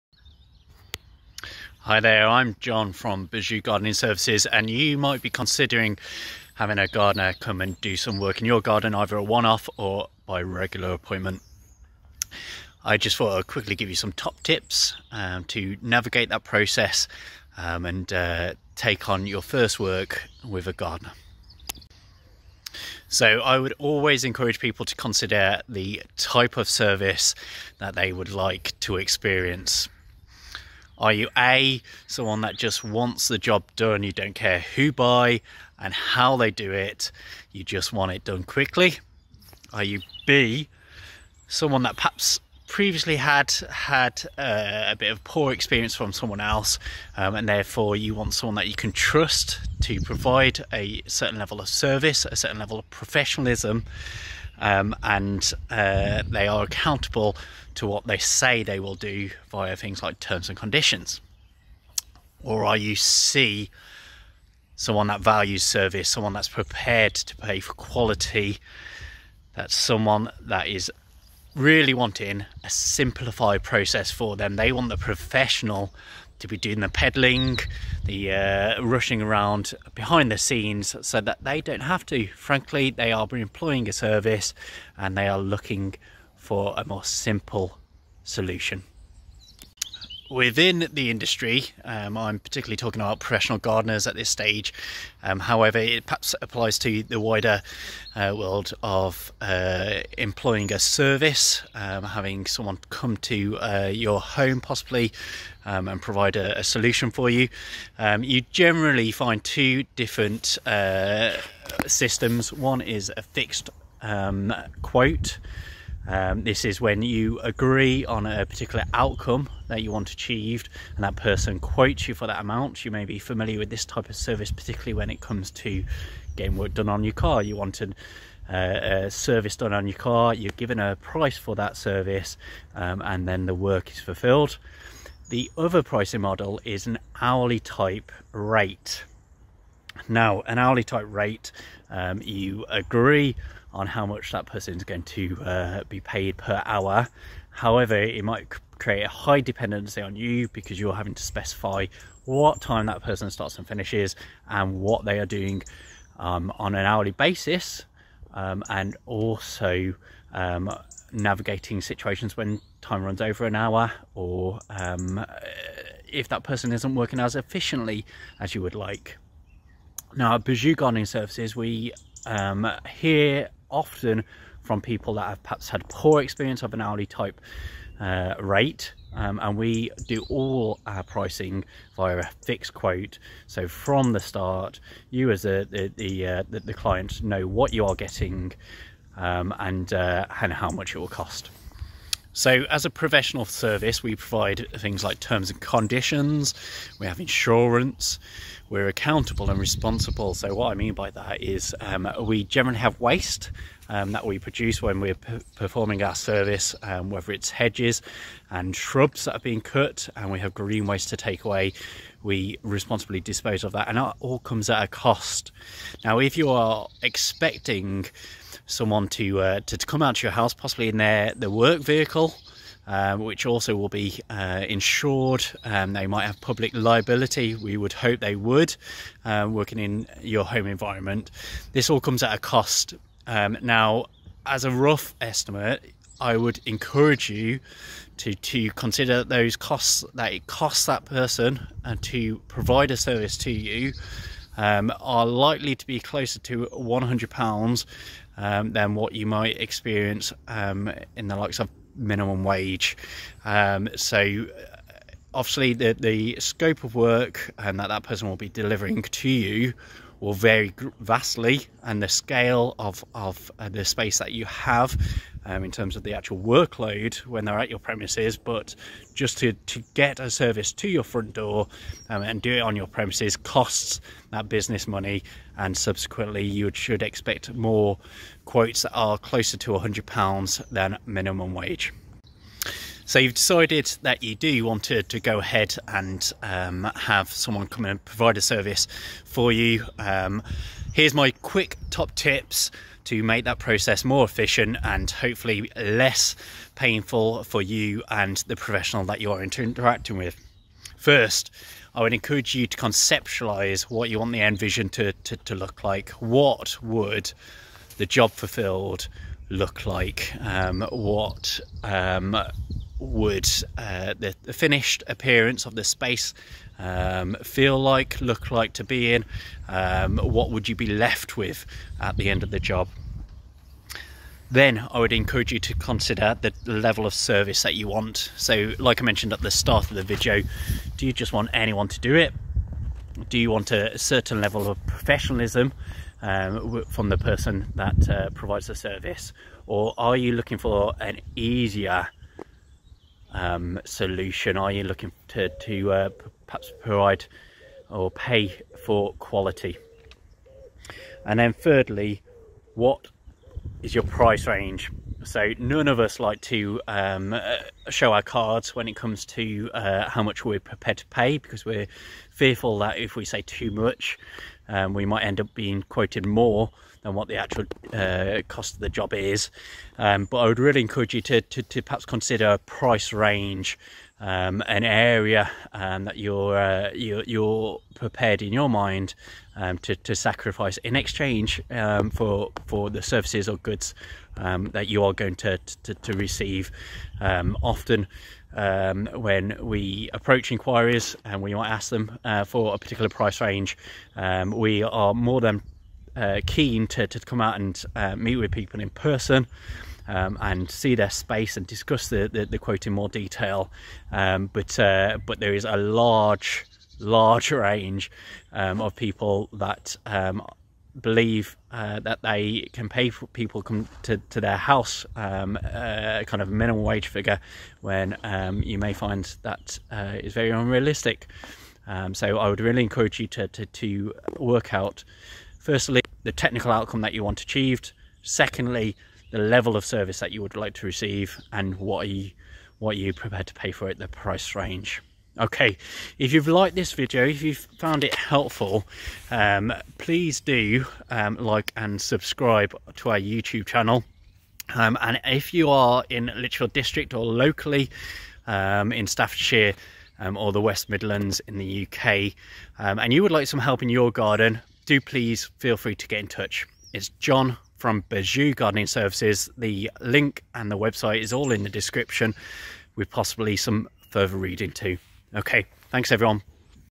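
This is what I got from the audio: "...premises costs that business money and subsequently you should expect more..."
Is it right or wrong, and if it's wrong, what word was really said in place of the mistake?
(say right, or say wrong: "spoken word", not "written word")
right.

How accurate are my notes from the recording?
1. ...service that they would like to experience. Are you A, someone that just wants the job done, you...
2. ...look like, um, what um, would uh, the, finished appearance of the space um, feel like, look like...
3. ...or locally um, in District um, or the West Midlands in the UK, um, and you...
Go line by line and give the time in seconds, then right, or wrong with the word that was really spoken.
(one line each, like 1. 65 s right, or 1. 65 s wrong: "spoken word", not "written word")
1. 26 s right
2. 309 s right
3. 447 s wrong: "Staffordshire", not "District".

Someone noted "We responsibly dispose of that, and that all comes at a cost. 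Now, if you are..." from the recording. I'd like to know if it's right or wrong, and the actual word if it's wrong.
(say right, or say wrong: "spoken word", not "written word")
right.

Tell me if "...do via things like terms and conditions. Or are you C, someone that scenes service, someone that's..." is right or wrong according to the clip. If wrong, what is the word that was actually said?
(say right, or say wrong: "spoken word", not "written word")
wrong: "values", not "scenes".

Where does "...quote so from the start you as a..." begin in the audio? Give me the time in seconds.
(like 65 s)
182 s.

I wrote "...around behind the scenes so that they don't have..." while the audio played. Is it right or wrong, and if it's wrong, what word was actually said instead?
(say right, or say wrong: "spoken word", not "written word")
right.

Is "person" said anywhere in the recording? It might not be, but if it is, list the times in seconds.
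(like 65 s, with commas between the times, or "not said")
121 s, 144 s, 153 s, 166 s, 241 s, 258 s, 337 s, 398 s.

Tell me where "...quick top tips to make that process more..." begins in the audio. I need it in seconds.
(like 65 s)
291 s.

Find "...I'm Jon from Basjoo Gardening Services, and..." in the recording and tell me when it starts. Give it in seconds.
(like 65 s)
2 s.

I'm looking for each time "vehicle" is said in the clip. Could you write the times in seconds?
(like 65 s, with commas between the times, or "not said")
221 s.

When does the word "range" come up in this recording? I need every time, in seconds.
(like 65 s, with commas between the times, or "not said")
354 s, 373 s, 393 s, 407 s, 434 s.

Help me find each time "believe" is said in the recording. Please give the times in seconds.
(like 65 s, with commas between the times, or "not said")
411 s.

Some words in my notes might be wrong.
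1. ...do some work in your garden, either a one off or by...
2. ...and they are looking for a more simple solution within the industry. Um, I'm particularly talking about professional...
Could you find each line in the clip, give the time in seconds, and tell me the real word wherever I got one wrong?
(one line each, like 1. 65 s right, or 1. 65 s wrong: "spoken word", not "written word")
1. 7 s right
2. 84 s right.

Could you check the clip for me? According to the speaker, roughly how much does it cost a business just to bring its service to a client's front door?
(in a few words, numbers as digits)
£100.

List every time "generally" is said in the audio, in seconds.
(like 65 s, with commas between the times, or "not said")
108 s, 202 s.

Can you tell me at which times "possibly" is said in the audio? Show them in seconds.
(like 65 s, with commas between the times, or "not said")
104 s, 220 s, 463 s.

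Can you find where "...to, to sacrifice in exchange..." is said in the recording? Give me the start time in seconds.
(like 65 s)
379 s.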